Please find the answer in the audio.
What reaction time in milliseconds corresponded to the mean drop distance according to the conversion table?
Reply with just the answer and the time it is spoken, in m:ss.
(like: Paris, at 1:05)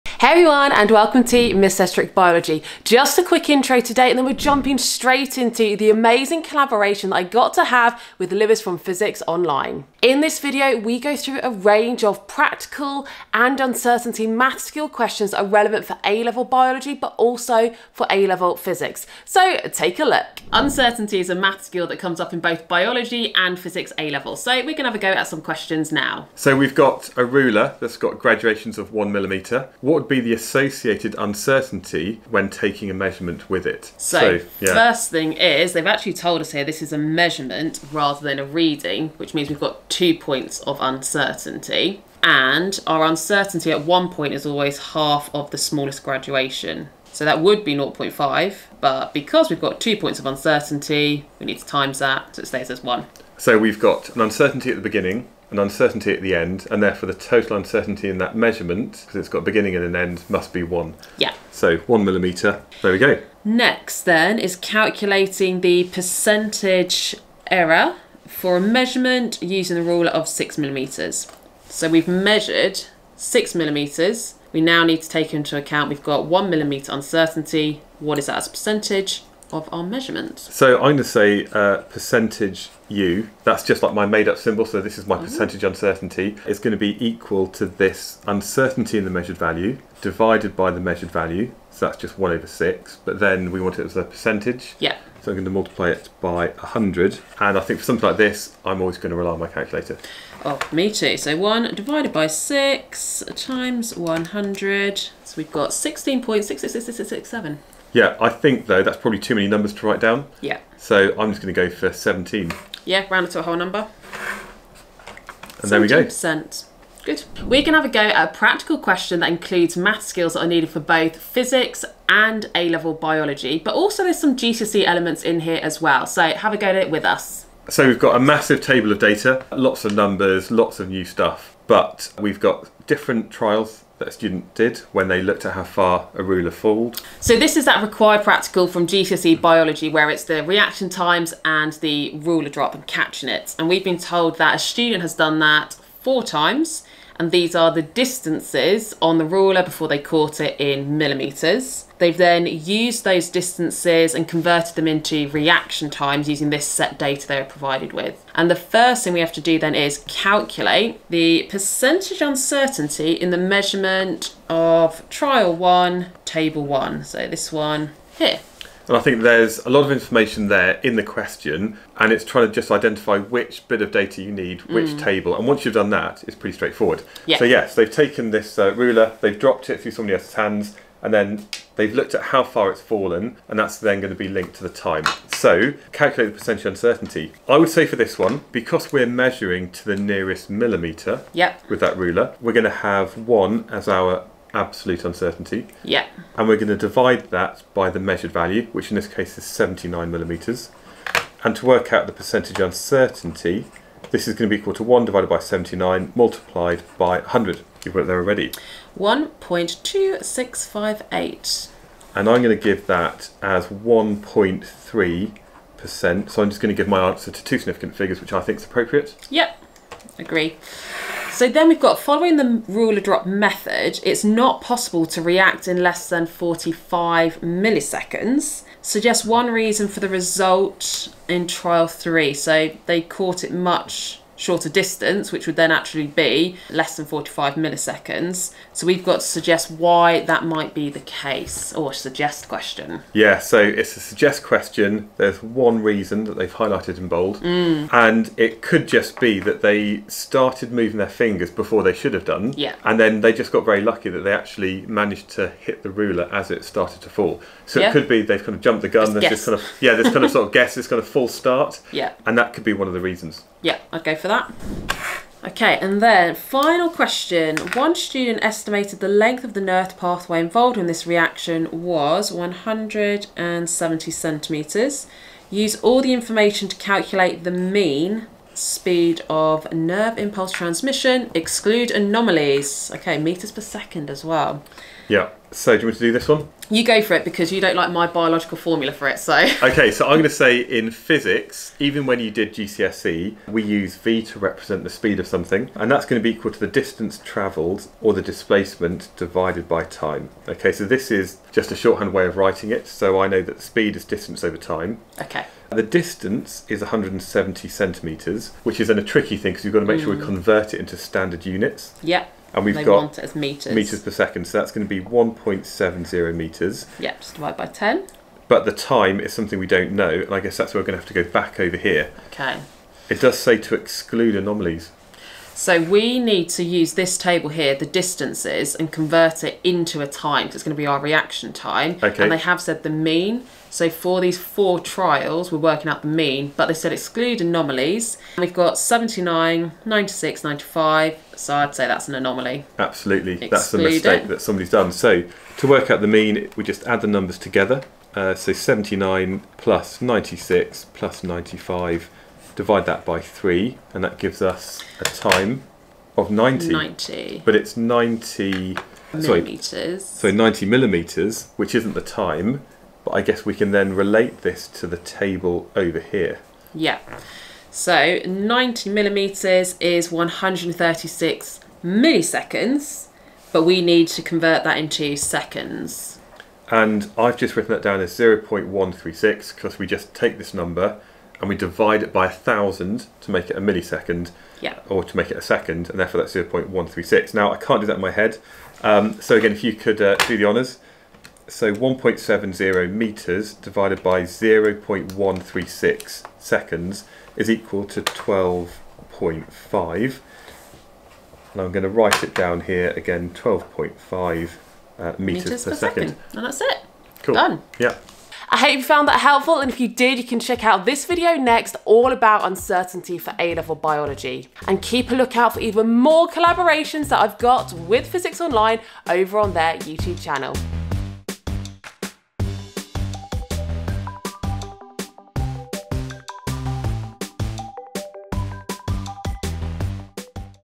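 136 milliseconds, at 6:10.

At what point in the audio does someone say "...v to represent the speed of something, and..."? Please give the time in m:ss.
4:53.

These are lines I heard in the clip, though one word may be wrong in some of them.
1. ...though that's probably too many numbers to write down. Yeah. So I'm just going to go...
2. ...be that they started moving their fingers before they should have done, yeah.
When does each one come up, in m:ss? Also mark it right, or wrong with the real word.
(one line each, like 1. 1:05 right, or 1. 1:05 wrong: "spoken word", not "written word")
1. 1:48 right
2. 4:09 right.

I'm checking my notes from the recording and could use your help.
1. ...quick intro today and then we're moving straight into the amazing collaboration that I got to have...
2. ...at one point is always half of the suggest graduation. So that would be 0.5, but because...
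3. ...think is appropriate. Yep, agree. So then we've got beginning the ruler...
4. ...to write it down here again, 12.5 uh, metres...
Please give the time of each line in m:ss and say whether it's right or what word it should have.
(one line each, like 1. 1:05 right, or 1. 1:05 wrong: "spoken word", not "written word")
1. 0:03 wrong: "jumping", not "moving"
2. 0:43 wrong: "smallest", not "suggest"
3. 3:38 wrong: "following", not "beginning"
4. 6:41 right.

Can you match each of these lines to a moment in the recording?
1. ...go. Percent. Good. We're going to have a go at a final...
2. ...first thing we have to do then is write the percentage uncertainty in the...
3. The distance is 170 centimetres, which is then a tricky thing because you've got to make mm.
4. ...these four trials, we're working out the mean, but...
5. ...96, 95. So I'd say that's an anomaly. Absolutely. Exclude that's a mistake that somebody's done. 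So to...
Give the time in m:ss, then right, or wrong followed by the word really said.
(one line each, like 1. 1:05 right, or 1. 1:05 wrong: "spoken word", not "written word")
1. 1:55 wrong: "practical", not "final"
2. 2:38 wrong: "calculate", not "write"
3. 5:05 right
4. 5:34 right
5. 5:39 right.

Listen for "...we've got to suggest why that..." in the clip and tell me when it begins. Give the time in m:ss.
3:58.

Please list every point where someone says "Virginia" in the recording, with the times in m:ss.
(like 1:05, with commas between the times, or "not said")
not said.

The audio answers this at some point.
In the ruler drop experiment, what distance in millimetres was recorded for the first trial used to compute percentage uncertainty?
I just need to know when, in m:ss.
3:19.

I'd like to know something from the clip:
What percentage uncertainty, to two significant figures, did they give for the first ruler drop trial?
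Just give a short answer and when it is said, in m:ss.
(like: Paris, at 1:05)
1.3%, at 3:33.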